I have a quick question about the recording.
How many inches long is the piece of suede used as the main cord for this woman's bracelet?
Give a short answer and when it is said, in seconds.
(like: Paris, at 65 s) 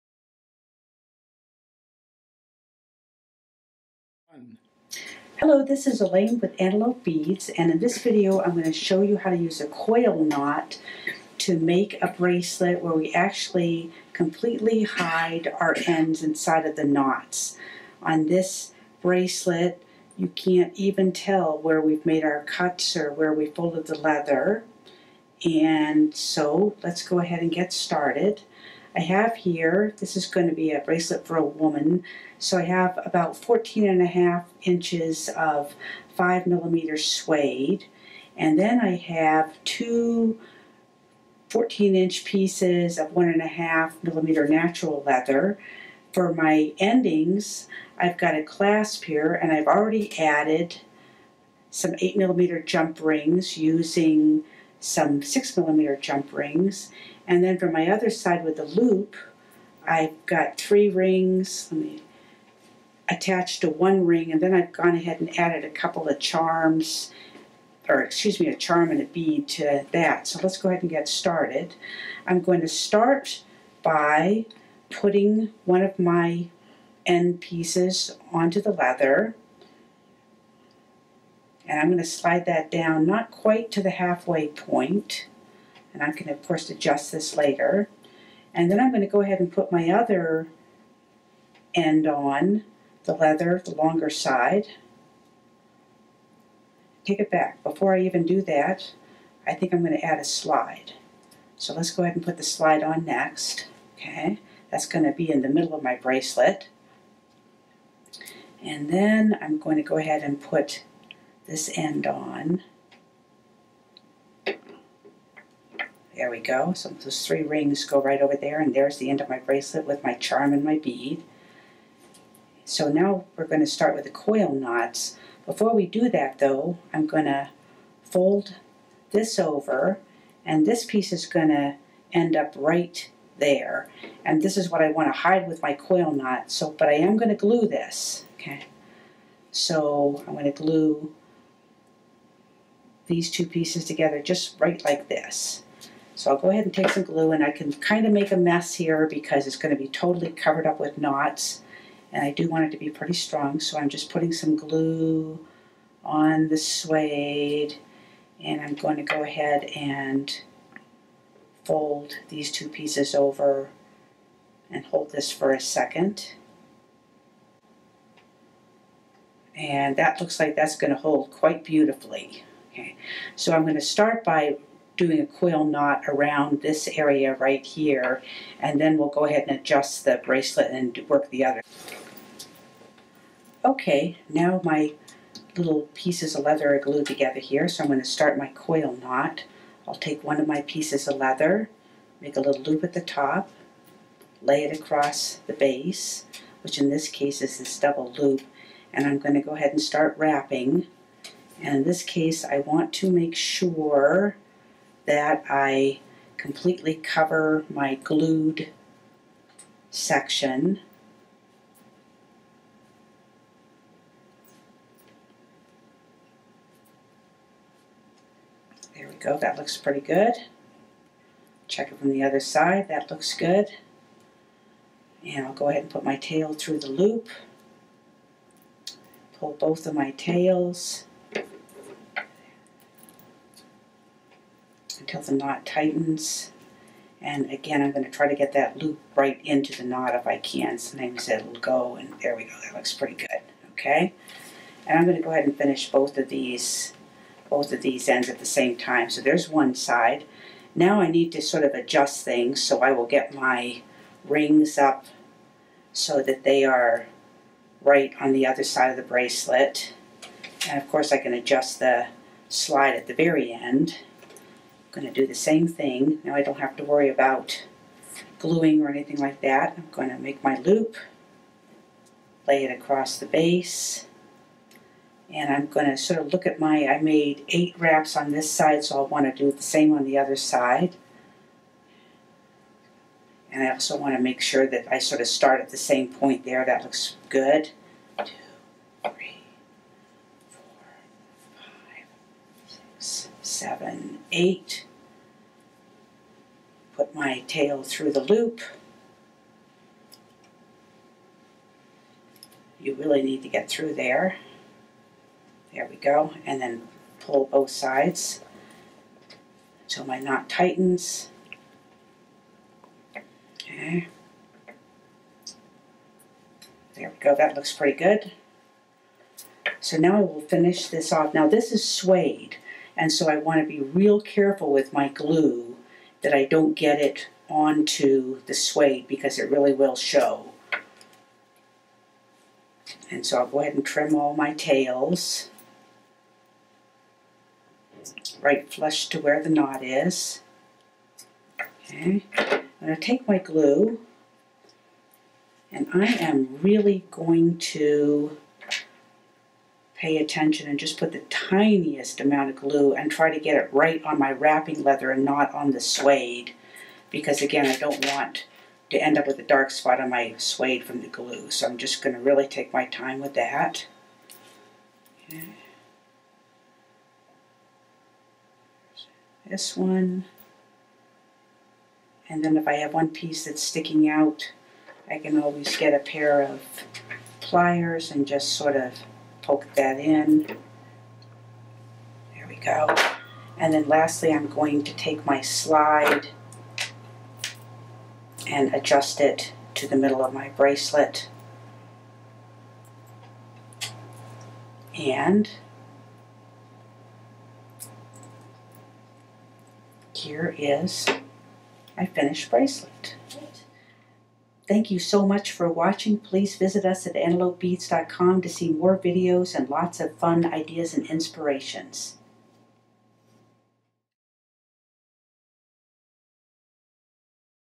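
14 and a half inches, at 33 s.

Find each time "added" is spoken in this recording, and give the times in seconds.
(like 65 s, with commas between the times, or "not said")
50 s, 65 s.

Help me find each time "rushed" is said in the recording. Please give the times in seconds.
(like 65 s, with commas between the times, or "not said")
not said.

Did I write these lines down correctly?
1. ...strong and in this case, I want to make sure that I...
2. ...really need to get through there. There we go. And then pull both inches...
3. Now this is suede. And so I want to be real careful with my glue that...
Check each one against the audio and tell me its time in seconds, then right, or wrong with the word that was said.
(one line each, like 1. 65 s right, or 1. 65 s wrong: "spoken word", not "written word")
1. 200 s wrong: "wrapping", not "strong"
2. 302 s wrong: "sides", not "inches"
3. 321 s right.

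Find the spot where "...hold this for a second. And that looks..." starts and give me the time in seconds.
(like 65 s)
164 s.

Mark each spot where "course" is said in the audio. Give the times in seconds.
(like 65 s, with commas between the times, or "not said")
86 s, 260 s.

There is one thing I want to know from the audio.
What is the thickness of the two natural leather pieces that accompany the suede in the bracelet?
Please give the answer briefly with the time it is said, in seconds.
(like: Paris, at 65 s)
1.5 millimeter, at 43 s.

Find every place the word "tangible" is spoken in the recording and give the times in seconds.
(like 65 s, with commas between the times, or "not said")
not said.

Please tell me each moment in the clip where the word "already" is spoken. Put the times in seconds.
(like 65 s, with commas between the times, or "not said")
49 s.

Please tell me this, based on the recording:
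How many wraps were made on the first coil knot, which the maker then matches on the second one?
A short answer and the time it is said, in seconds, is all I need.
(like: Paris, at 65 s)
8, at 277 s.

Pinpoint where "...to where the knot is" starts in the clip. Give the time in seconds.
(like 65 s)
339 s.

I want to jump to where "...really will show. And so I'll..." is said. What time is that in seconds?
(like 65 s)
329 s.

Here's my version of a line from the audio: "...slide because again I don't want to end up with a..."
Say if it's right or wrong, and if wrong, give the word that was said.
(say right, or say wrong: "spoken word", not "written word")
wrong: "suede", not "slide".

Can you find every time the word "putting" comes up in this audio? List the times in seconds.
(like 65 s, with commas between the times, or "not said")
74 s, 154 s.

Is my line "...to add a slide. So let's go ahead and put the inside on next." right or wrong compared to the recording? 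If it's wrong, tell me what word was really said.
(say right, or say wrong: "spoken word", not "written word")
wrong: "slide", not "inside".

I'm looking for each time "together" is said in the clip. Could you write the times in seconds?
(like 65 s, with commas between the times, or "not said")
143 s, 187 s.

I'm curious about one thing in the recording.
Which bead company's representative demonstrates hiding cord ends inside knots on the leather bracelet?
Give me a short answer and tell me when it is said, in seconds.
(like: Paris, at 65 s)
Antelope Beads, at 6 s.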